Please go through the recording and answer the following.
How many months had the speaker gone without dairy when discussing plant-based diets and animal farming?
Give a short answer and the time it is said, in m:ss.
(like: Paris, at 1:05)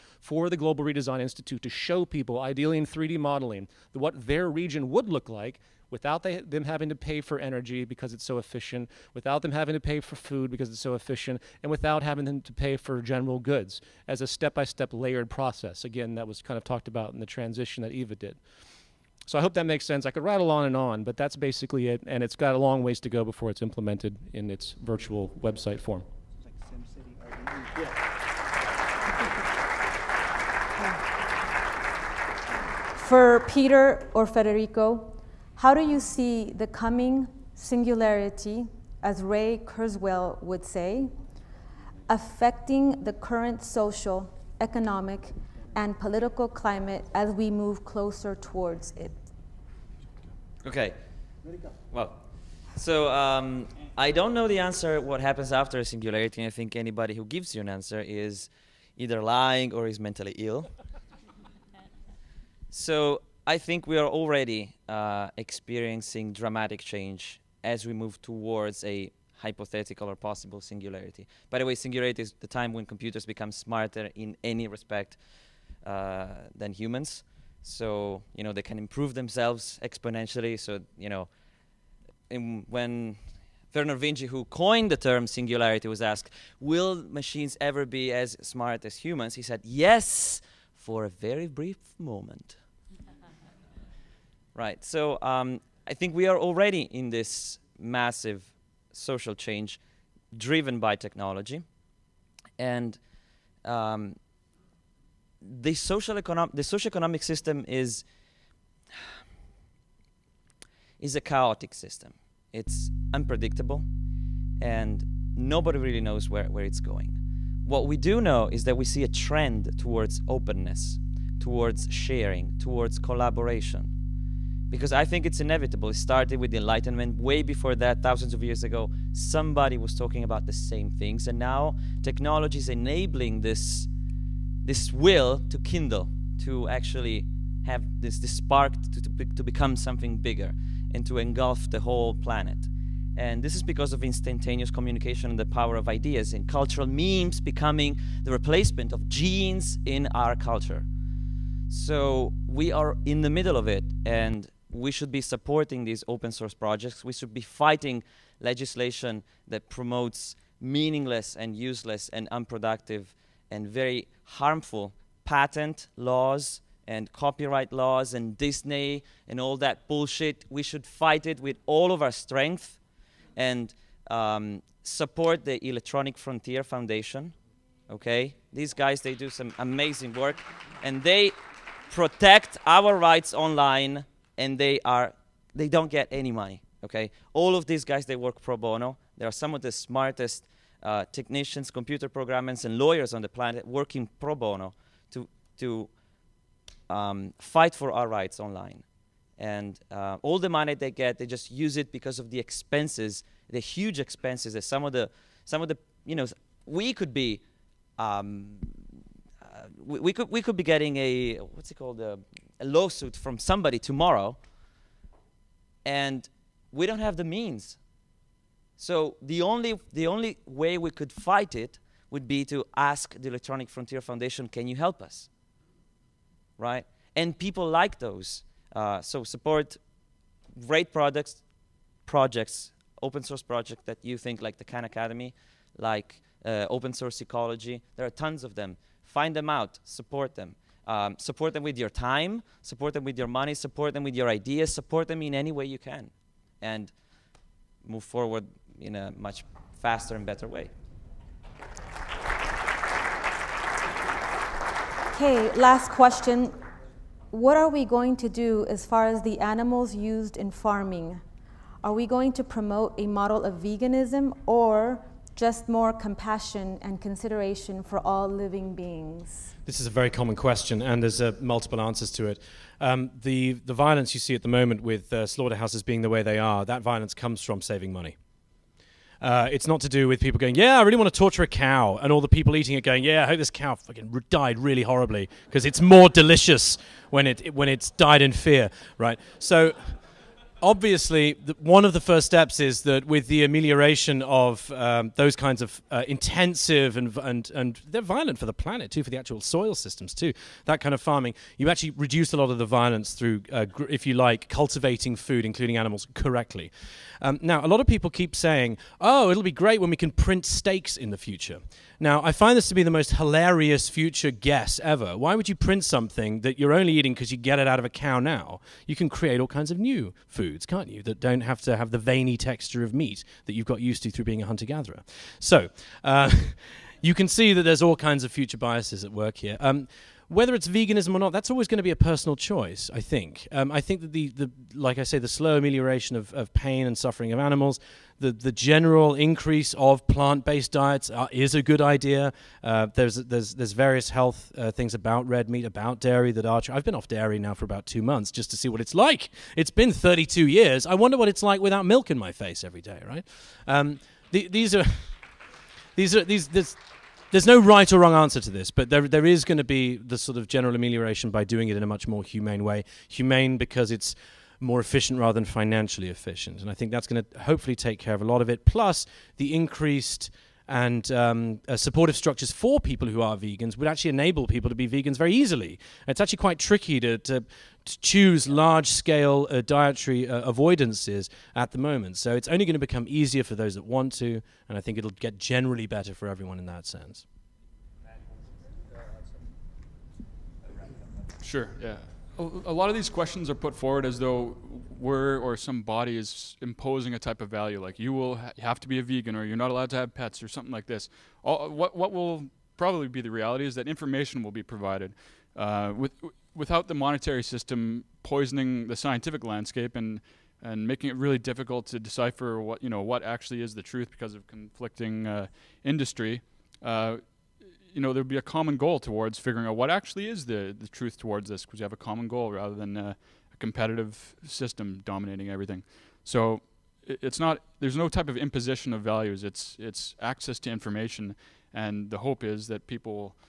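2, at 5:47.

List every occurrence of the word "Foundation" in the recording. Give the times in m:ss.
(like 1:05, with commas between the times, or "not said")
2:56, 3:44.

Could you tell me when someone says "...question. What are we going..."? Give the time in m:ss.
4:15.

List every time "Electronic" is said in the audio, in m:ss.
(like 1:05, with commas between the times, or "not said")
2:55, 3:43.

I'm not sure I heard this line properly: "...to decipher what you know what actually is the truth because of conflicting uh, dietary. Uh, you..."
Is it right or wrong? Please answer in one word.
wrong.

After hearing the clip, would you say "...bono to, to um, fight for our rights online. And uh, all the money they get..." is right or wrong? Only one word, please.
right.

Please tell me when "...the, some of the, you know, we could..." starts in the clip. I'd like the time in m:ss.
3:24.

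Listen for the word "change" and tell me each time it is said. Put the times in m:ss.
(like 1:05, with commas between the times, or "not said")
1:06, 1:39.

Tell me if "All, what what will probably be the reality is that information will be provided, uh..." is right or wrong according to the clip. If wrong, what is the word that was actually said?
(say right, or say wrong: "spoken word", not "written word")
right.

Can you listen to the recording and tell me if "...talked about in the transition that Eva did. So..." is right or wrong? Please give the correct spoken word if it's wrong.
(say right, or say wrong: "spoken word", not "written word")
right.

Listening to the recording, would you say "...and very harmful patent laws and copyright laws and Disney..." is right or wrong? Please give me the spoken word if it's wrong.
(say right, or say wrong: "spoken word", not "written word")
right.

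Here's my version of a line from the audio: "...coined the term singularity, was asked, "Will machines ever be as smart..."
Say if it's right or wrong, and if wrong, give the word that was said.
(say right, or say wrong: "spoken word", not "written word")
right.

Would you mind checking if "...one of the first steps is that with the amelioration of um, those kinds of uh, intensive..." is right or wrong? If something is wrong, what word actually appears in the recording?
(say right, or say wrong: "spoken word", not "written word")
right.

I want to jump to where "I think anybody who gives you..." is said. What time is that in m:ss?
0:56.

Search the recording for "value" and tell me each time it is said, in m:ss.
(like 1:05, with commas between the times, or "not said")
6:37, 7:09.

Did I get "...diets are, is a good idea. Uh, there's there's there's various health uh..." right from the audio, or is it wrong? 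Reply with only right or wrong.
right.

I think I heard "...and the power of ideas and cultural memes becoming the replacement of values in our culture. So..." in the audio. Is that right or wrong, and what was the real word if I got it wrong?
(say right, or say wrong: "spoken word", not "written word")
wrong: "genes", not "values".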